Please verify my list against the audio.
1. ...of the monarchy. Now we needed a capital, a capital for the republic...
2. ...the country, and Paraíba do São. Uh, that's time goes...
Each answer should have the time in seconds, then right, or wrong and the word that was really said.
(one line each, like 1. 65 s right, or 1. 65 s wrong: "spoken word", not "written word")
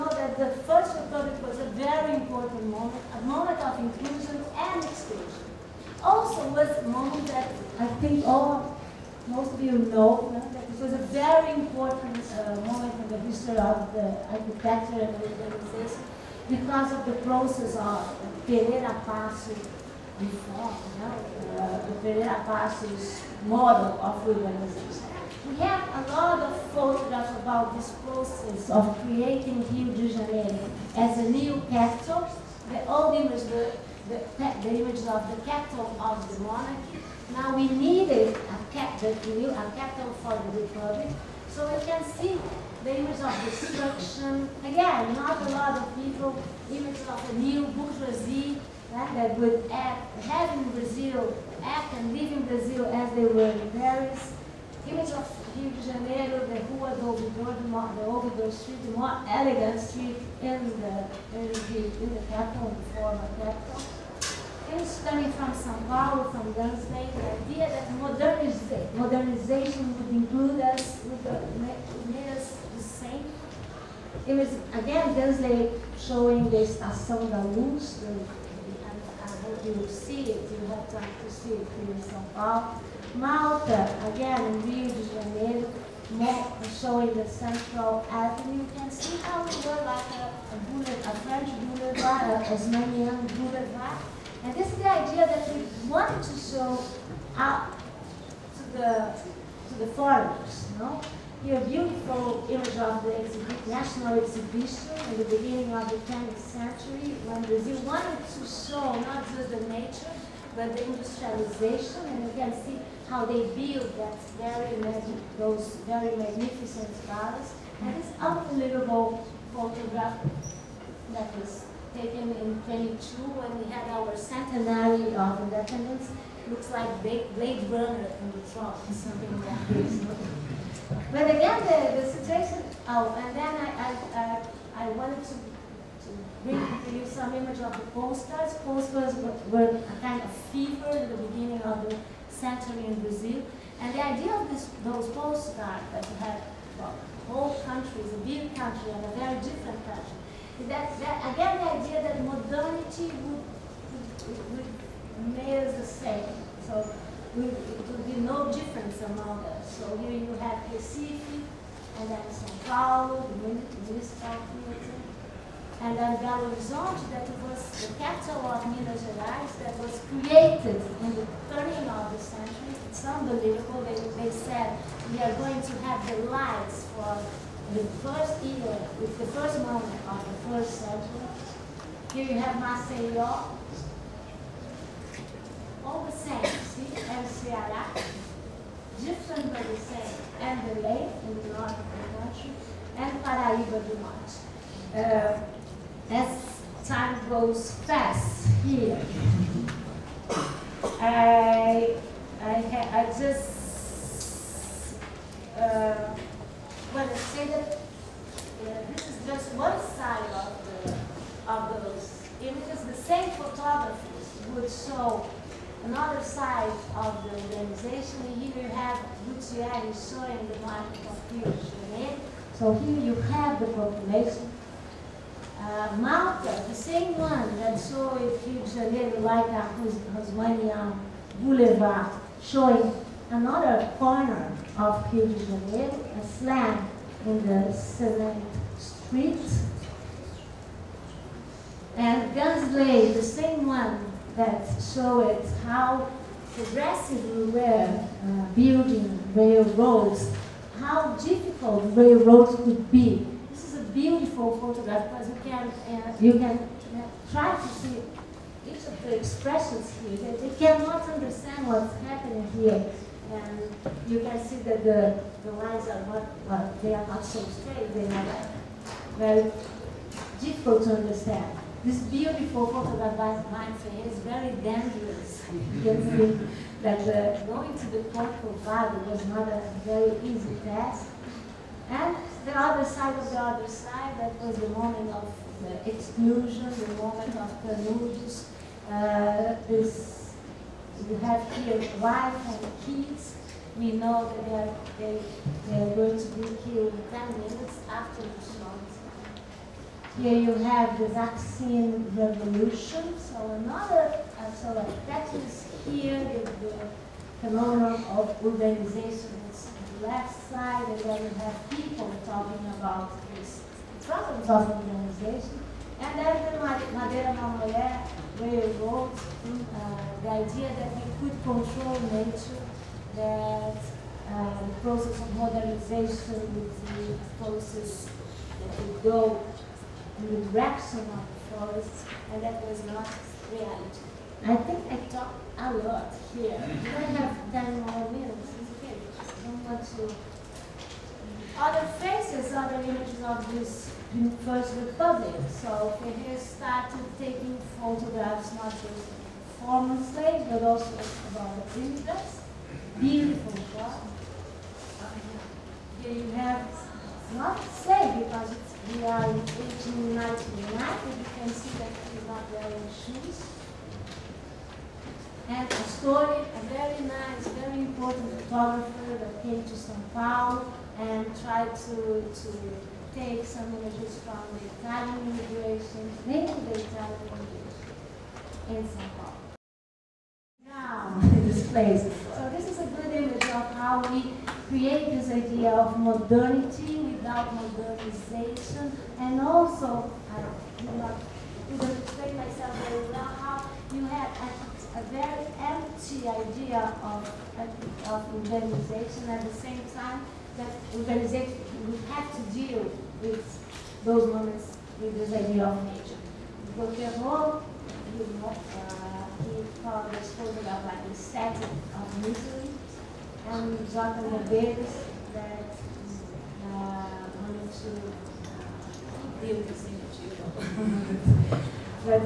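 1. 36 s right
2. 191 s wrong: "Norte", not "São".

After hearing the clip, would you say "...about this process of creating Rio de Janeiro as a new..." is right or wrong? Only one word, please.
right.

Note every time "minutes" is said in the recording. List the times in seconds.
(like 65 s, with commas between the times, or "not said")
297 s, 338 s.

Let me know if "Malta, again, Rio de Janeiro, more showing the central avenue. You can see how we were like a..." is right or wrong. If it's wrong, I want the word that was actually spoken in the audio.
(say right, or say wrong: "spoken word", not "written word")
right.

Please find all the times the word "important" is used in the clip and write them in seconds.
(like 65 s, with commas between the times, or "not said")
2 s, 11 s, 367 s.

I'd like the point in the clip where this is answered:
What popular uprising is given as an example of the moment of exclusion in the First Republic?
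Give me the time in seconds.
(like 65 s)
301 s.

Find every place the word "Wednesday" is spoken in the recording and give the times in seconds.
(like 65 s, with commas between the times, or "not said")
66 s, 75 s.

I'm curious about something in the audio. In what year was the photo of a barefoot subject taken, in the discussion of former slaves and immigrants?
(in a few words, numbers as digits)
1899.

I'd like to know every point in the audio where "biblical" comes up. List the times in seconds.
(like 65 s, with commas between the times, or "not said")
not said.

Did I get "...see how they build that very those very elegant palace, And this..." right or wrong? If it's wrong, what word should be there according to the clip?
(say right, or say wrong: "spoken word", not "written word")
wrong: "magnificent", not "elegant".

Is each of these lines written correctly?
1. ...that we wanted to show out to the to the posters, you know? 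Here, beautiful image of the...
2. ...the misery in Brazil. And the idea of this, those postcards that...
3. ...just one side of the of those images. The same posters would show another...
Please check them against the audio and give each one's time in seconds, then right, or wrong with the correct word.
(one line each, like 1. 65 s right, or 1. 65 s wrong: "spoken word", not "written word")
1. 95 s wrong: "foreigners", not "posters"
2. 141 s wrong: "century", not "misery"
3. 209 s wrong: "photographers", not "posters".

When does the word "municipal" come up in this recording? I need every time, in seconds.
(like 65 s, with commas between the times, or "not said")
163 s.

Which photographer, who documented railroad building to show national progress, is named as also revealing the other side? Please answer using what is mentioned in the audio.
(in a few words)
Gaensly.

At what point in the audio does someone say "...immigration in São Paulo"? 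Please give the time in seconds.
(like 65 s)
377 s.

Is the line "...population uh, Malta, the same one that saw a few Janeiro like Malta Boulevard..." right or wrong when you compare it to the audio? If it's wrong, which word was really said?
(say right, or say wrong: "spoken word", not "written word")
wrong: "Rosmania", not "Malta".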